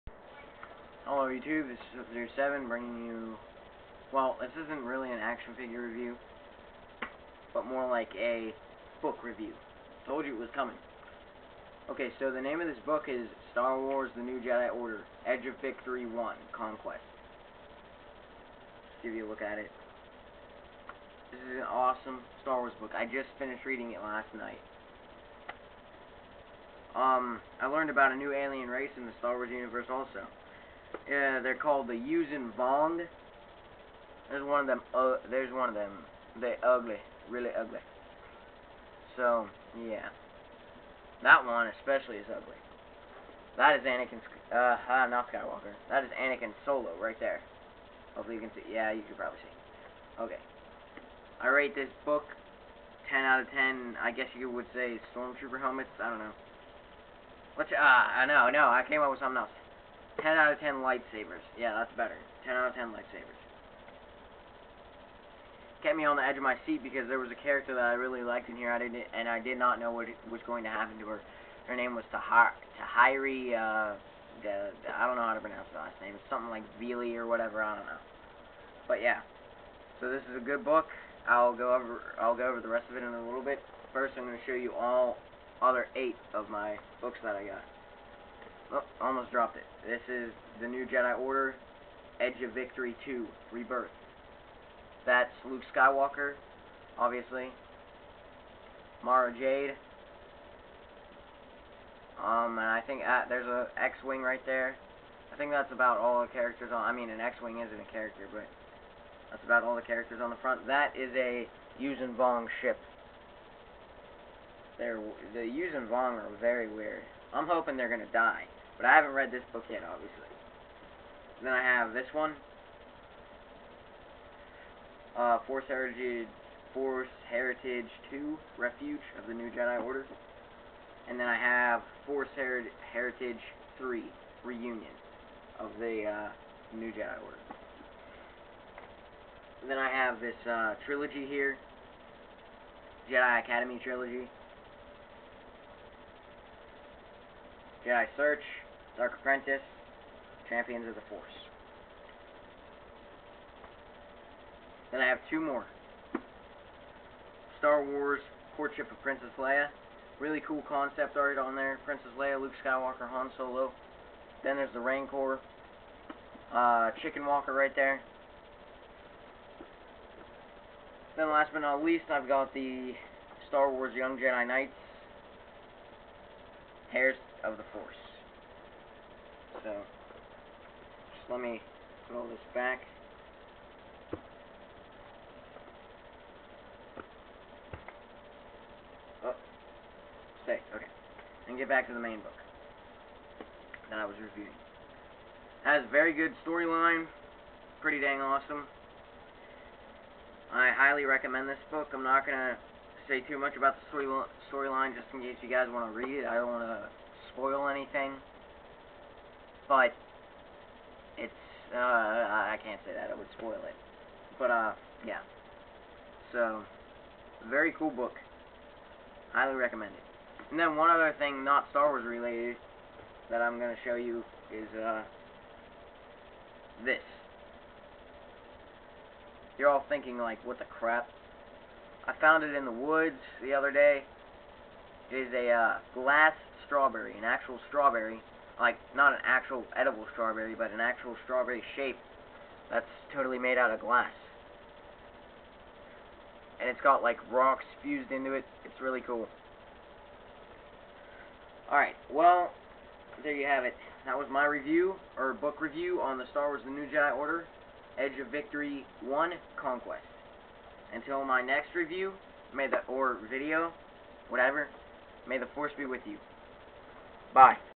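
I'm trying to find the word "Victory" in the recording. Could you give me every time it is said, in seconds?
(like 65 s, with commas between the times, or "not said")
15 s, 92 s, 258 s.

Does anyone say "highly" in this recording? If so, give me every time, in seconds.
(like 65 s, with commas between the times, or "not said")
200 s, 219 s.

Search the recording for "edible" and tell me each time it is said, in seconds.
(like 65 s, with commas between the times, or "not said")
239 s.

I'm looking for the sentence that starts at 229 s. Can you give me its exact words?
You're all thinking like, what the crap?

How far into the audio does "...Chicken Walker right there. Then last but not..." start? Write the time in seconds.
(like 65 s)
167 s.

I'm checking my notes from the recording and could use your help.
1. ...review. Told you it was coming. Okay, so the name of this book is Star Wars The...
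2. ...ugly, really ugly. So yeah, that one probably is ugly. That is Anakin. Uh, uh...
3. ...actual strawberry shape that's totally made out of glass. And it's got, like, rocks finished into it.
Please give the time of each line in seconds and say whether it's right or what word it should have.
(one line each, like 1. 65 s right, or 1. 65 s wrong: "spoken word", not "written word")
1. 9 s right
2. 36 s wrong: "especially", not "probably"
3. 240 s wrong: "fused", not "finished".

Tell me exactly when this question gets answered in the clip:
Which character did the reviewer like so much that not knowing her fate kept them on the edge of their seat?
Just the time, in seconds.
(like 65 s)
72 s.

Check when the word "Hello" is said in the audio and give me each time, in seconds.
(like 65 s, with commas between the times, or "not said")
1 s.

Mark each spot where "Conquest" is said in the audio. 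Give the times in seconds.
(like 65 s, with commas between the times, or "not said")
16 s, 259 s.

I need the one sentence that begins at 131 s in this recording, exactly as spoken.
And then I have Force Her Heritage 3, Reunion of the uh, New Jedi Order.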